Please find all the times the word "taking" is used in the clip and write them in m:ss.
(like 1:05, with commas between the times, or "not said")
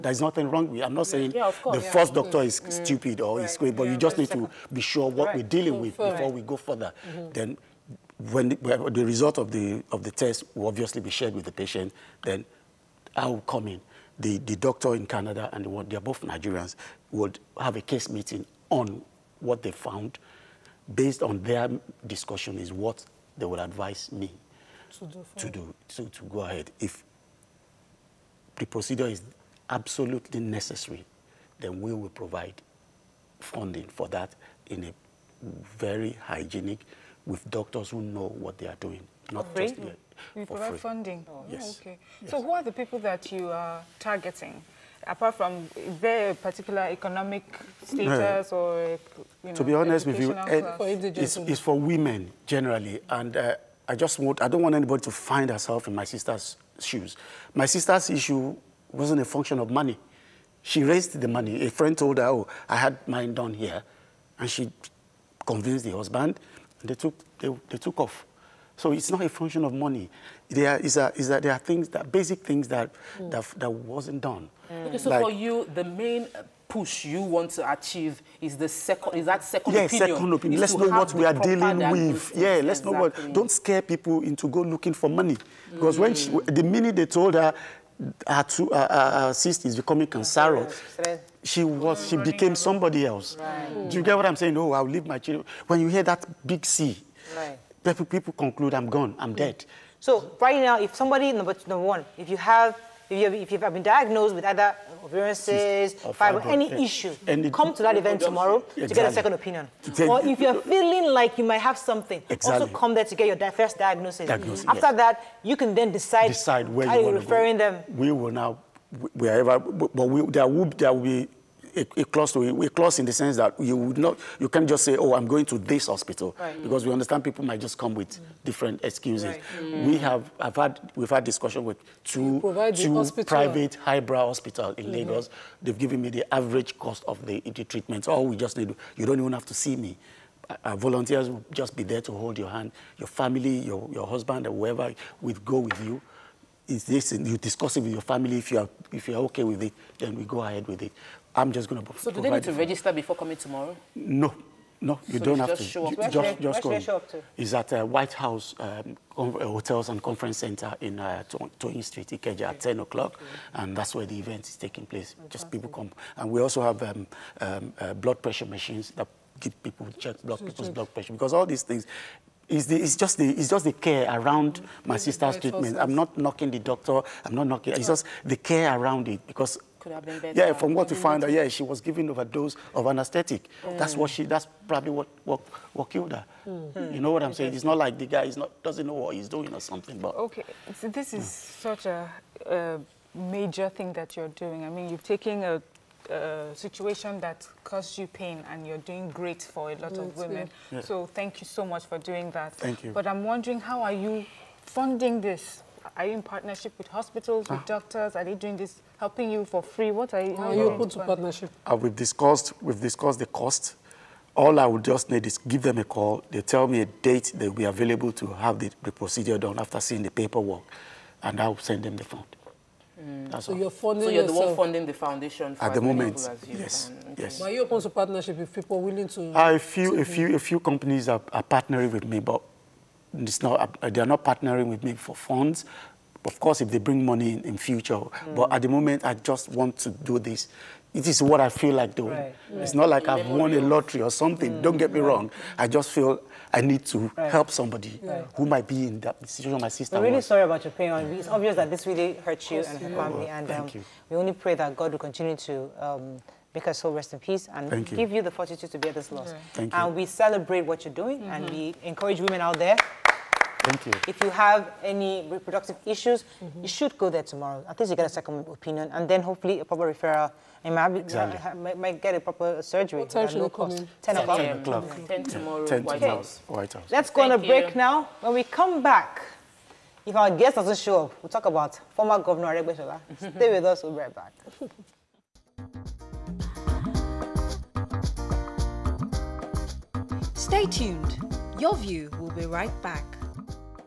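2:44, 3:15.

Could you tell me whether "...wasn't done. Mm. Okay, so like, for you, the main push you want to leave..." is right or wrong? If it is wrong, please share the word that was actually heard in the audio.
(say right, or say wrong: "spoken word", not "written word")
wrong: "achieve", not "leave".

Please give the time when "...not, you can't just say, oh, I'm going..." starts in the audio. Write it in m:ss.
2:03.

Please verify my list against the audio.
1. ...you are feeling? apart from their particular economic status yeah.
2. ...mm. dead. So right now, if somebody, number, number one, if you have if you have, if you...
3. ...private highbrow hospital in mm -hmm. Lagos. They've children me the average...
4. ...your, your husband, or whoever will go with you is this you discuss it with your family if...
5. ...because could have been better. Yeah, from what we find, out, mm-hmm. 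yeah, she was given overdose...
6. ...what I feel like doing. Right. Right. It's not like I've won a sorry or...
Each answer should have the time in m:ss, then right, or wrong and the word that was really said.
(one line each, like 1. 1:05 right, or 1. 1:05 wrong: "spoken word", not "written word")
1. 0:43 wrong: "targeting", not "feeling"
2. 1:39 right
3. 2:13 wrong: "given", not "children"
4. 2:23 right
5. 2:59 right
6. 4:01 wrong: "lottery", not "sorry".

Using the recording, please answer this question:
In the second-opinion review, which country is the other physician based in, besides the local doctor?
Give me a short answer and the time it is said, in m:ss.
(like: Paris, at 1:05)
Canada, at 0:15.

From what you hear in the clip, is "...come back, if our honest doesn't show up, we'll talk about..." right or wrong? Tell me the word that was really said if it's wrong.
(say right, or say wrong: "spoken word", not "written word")
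wrong: "guest", not "honest".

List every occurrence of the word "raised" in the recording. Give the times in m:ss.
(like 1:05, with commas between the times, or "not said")
1:00.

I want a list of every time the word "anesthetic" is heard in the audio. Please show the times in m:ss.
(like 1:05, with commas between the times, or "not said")
3:02.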